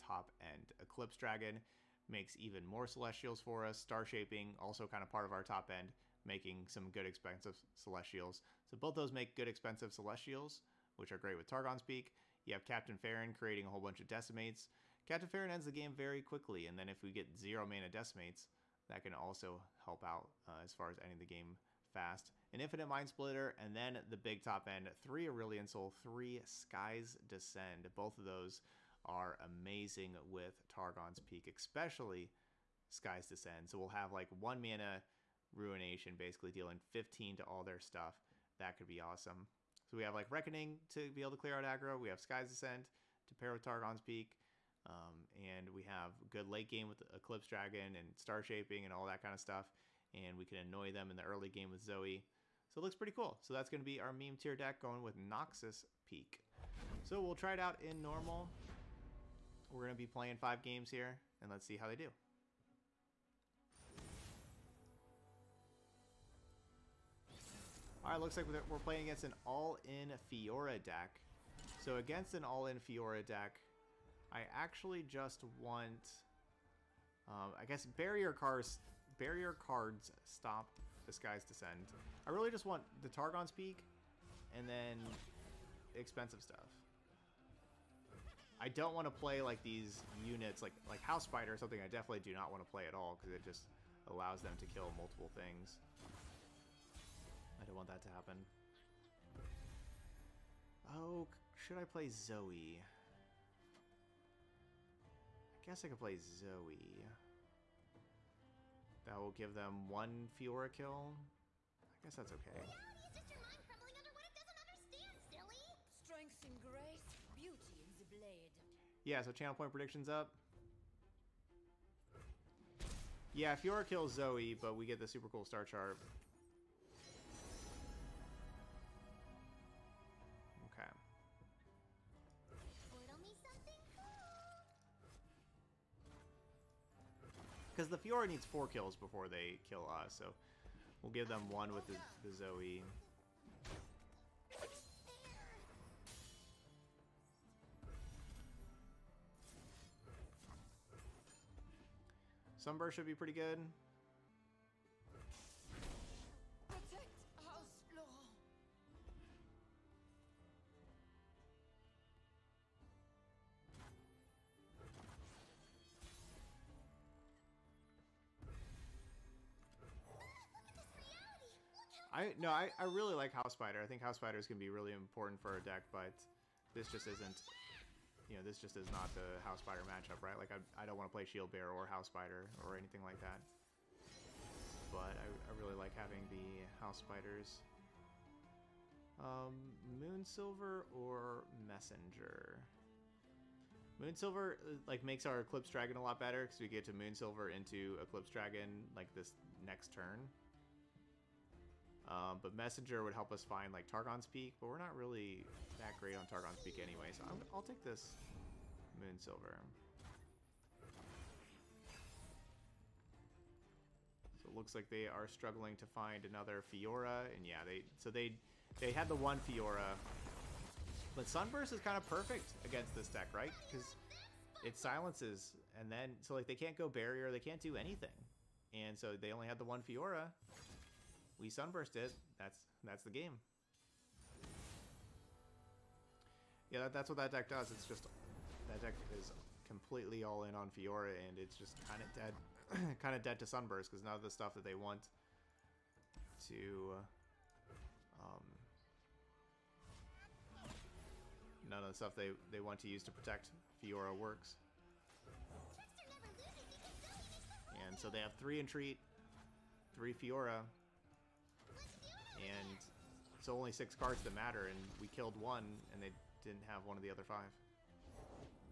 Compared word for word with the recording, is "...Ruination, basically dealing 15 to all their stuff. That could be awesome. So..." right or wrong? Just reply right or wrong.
right.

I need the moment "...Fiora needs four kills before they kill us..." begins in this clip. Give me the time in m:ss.
2:17.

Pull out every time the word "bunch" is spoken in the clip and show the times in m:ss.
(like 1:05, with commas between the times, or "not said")
0:13.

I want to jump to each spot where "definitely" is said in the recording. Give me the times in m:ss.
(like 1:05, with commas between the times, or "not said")
1:31.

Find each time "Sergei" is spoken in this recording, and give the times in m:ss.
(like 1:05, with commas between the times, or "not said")
not said.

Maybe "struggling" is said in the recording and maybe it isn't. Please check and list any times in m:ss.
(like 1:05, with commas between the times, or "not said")
3:35.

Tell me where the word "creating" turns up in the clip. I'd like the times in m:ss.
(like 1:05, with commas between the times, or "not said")
0:13.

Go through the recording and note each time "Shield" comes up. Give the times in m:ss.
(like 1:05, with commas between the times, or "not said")
3:01.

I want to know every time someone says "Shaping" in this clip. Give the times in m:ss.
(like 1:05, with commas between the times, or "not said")
0:04, 0:48.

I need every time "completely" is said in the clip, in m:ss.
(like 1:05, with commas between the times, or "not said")
3:59.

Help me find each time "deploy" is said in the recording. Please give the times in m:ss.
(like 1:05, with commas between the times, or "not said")
not said.